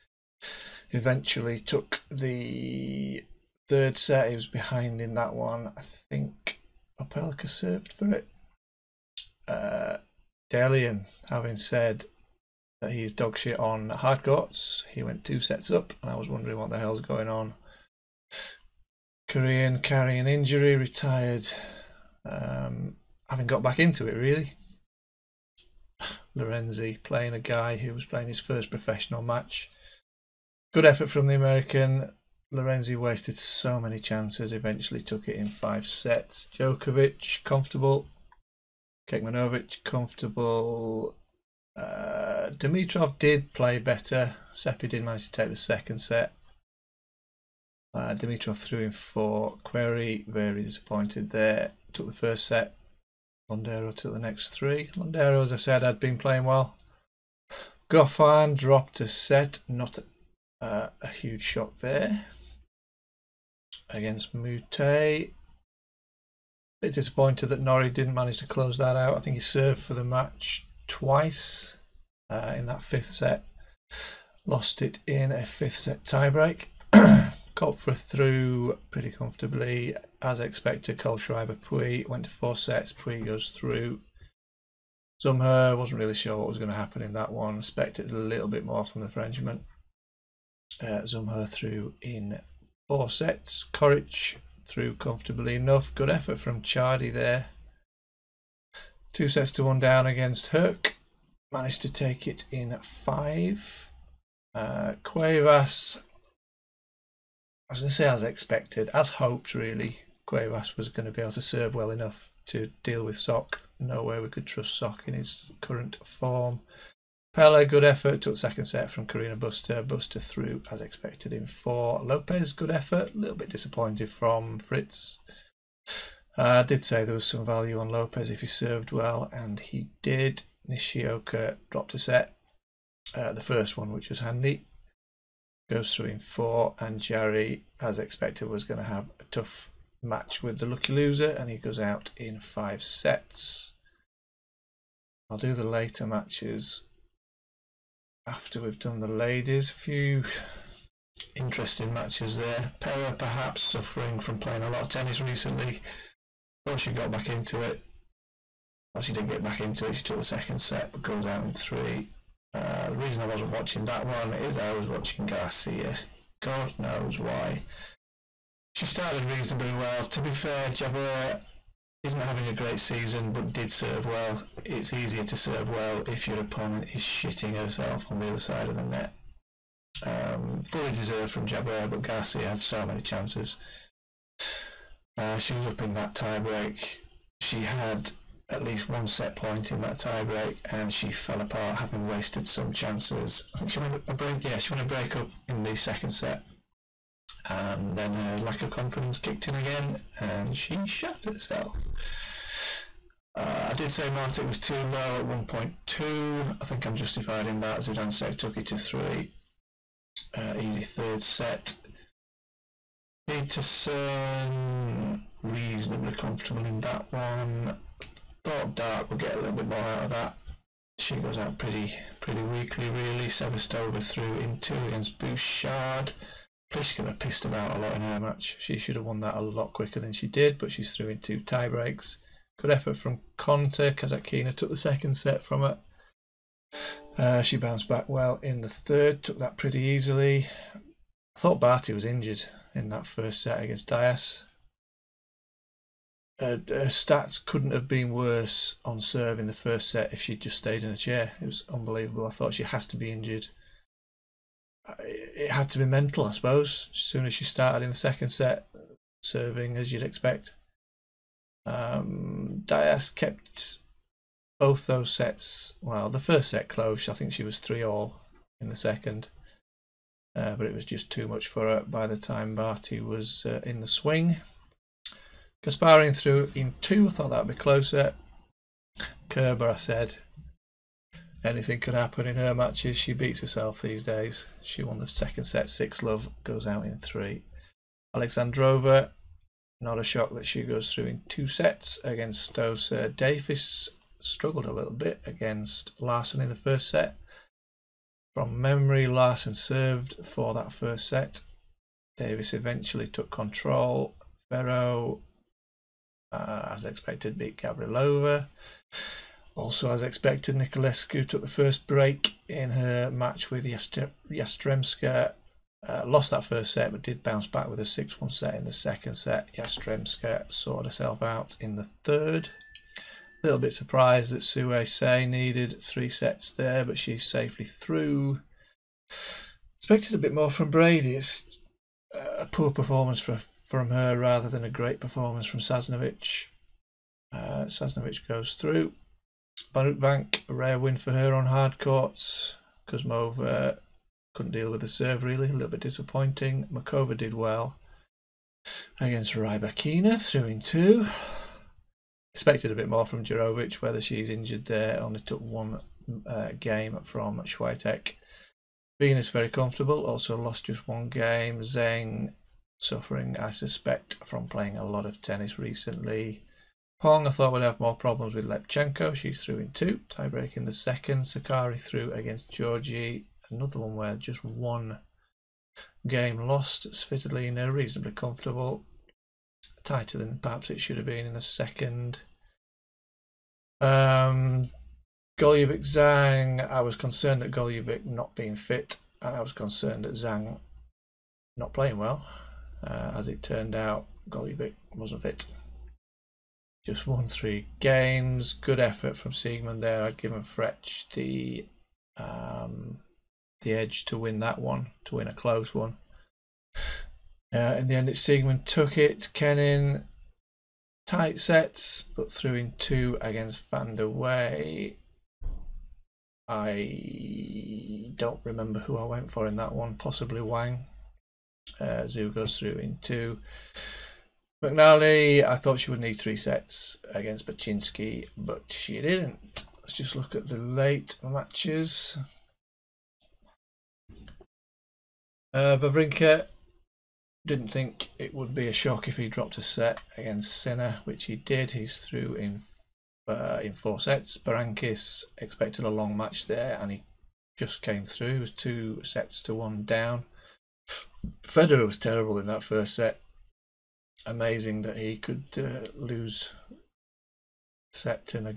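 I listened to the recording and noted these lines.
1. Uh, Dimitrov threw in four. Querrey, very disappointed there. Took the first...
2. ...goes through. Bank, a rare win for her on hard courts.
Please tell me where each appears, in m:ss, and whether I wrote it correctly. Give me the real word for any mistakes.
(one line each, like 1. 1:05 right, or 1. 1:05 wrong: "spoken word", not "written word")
1. 0:47 right
2. 5:38 right.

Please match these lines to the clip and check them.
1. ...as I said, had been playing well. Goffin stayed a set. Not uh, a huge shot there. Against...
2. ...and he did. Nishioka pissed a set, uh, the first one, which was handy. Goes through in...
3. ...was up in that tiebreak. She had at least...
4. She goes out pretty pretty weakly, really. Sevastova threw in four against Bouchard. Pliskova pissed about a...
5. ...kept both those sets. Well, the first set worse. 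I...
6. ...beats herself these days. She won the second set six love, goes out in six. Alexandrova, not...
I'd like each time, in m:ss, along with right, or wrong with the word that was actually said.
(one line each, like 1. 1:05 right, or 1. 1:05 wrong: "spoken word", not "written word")
1. 0:55 wrong: "dropped", not "stayed"
2. 2:09 wrong: "dropped", not "pissed"
3. 3:05 right
4. 3:40 wrong: "two", not "four"
5. 4:23 wrong: "close", not "worse"
6. 4:43 wrong: "three", not "six".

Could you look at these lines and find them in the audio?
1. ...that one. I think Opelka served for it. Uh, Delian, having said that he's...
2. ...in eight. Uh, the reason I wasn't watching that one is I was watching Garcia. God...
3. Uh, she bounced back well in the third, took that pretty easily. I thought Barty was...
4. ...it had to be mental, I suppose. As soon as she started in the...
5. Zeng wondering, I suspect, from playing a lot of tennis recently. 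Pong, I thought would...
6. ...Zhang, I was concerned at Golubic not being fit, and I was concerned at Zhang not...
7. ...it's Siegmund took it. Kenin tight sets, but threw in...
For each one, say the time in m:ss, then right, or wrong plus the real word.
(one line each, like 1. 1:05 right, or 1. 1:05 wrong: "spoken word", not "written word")
1. 0:05 right
2. 2:41 wrong: "three", not "eight"
3. 3:57 right
4. 4:14 right
5. 6:01 wrong: "suffering", not "wondering"
6. 6:25 right
7. 6:48 right.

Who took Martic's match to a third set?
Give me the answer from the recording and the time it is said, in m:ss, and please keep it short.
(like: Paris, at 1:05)
Zidansek, at 3:27.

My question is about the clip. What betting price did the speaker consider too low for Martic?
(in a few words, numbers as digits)
1.2.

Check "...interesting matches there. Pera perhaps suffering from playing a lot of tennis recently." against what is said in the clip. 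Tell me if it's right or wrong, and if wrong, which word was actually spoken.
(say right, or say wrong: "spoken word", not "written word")
right.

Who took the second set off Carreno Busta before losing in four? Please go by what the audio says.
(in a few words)
Pella.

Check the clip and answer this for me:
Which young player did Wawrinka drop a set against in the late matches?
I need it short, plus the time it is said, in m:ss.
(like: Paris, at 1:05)
Sinner, at 7:20.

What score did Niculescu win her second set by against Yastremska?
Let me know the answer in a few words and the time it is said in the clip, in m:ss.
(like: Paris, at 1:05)
6-1, at 5:17.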